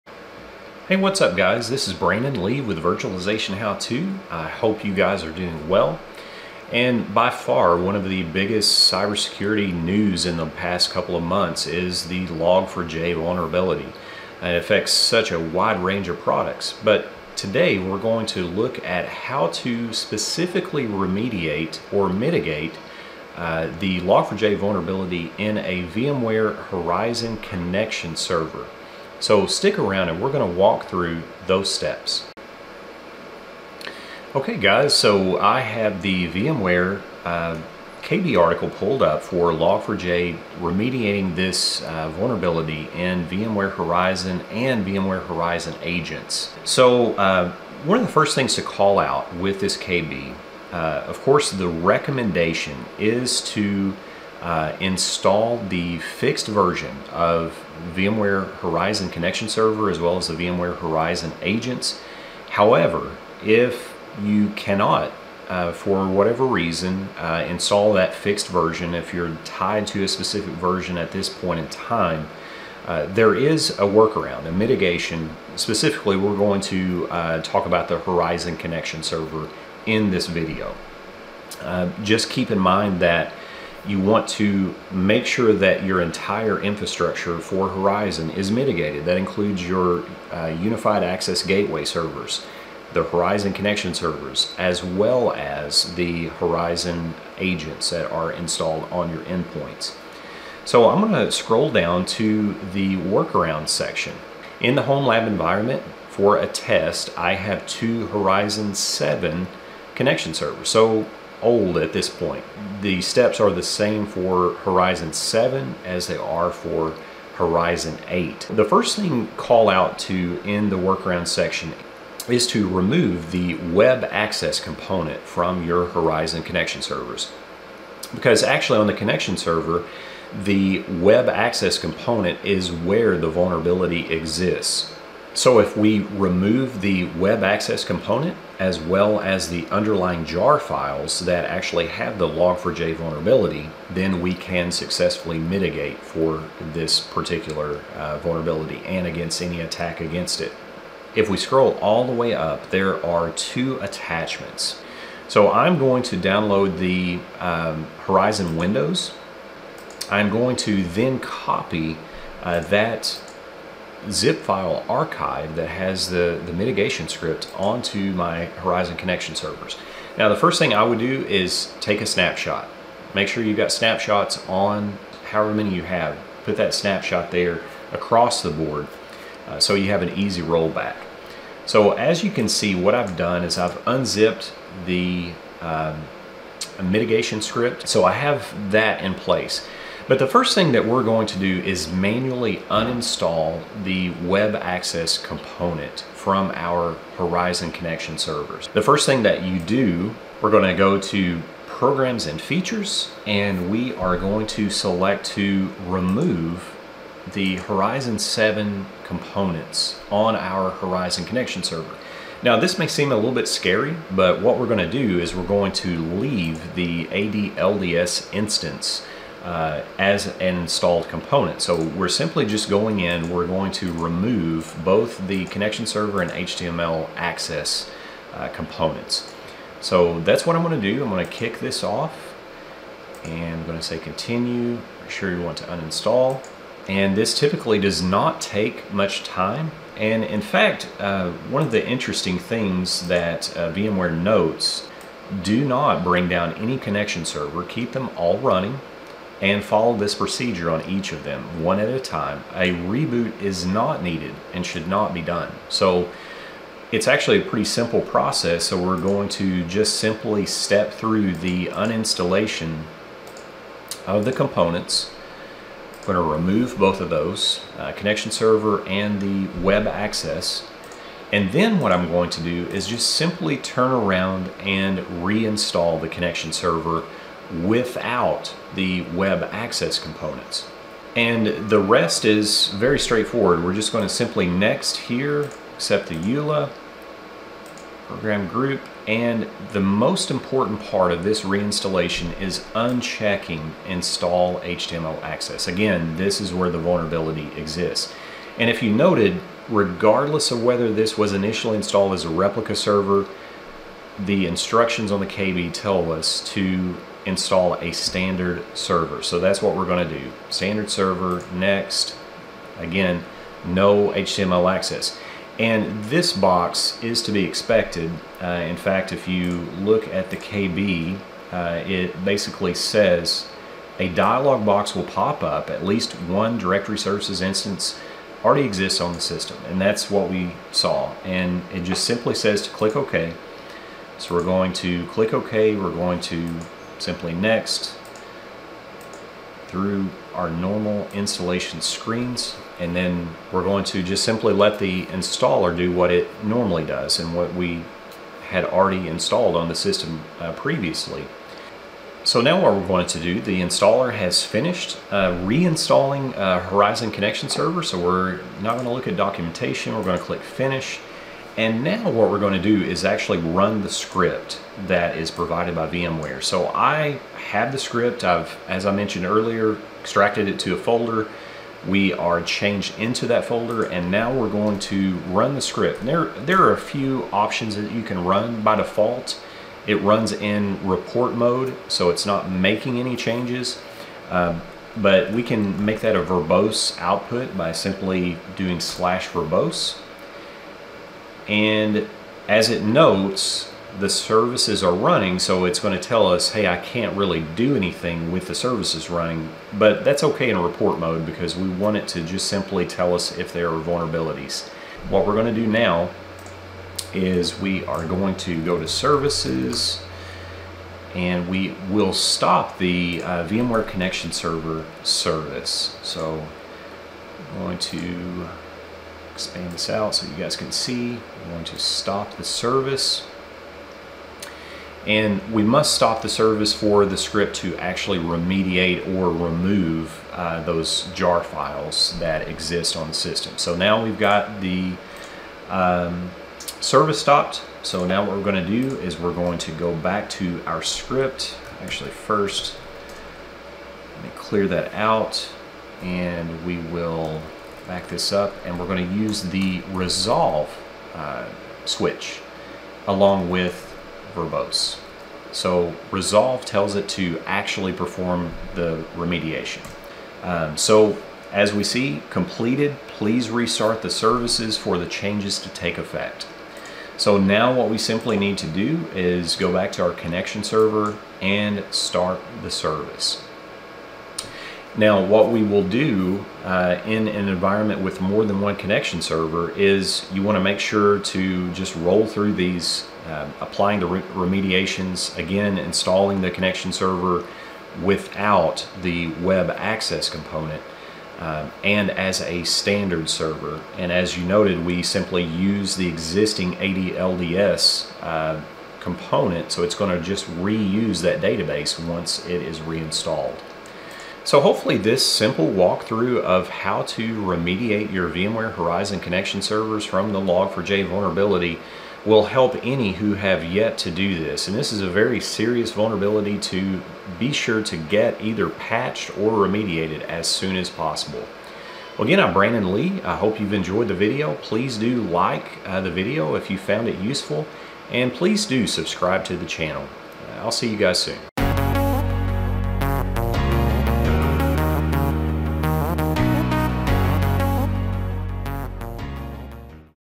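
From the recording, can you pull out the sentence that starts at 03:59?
And in fact, uh, one of the interesting things that uh, VMware notes, do not bring down any connection server.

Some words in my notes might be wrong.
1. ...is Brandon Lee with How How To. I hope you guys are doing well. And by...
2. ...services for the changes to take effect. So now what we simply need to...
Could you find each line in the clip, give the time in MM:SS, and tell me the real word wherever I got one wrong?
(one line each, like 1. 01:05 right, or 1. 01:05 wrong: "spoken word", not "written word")
1. 00:01 wrong: "Virtualization", not "How"
2. 07:44 right.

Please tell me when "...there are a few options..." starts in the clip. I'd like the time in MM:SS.
06:16.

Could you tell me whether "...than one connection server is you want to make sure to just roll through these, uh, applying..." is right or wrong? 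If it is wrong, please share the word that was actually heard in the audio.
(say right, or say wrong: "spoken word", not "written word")
right.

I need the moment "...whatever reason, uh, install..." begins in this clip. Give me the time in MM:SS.
01:06.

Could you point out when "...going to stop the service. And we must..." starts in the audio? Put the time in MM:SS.
07:01.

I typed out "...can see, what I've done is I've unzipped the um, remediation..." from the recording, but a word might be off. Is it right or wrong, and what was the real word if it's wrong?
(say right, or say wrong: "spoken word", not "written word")
wrong: "mitigation", not "remediation".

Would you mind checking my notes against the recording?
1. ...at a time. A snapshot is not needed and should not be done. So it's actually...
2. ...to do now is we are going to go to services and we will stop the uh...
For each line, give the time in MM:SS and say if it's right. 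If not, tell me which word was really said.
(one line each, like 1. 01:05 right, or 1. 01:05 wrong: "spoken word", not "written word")
1. 04:11 wrong: "reboot", not "snapshot"
2. 06:45 right.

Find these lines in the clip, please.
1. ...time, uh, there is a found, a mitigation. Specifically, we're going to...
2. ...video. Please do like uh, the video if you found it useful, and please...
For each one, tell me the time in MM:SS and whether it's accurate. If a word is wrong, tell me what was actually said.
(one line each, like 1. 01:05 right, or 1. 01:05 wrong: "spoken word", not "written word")
1. 01:11 wrong: "workaround", not "found"
2. 08:44 right.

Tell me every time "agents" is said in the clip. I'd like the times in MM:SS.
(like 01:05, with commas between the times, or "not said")
00:45, 01:01, 01:37.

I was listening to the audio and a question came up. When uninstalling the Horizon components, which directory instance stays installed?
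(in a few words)
AD LDS instance.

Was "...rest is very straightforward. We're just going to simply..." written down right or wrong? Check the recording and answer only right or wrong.
right.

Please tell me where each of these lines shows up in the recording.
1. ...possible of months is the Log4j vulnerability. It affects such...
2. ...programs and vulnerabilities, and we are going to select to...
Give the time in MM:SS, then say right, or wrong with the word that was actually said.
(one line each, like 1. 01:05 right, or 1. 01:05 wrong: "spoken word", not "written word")
1. 00:10 wrong: "couple", not "possible"
2. 03:21 wrong: "features", not "vulnerabilities".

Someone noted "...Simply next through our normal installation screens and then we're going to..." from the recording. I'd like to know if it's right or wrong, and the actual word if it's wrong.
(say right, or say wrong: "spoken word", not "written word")
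right.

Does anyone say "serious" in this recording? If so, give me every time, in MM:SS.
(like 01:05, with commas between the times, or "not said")
08:35.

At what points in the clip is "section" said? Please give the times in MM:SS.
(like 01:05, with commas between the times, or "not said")
01:43, 02:01.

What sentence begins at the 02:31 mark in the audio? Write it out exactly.
If we scroll all the way up, there are two attachments.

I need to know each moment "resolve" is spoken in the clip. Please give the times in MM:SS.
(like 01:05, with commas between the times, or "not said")
07:29, 07:36.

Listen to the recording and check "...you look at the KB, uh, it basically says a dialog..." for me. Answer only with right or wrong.
right.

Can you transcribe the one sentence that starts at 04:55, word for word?
Again, this is where the vulnerability exists.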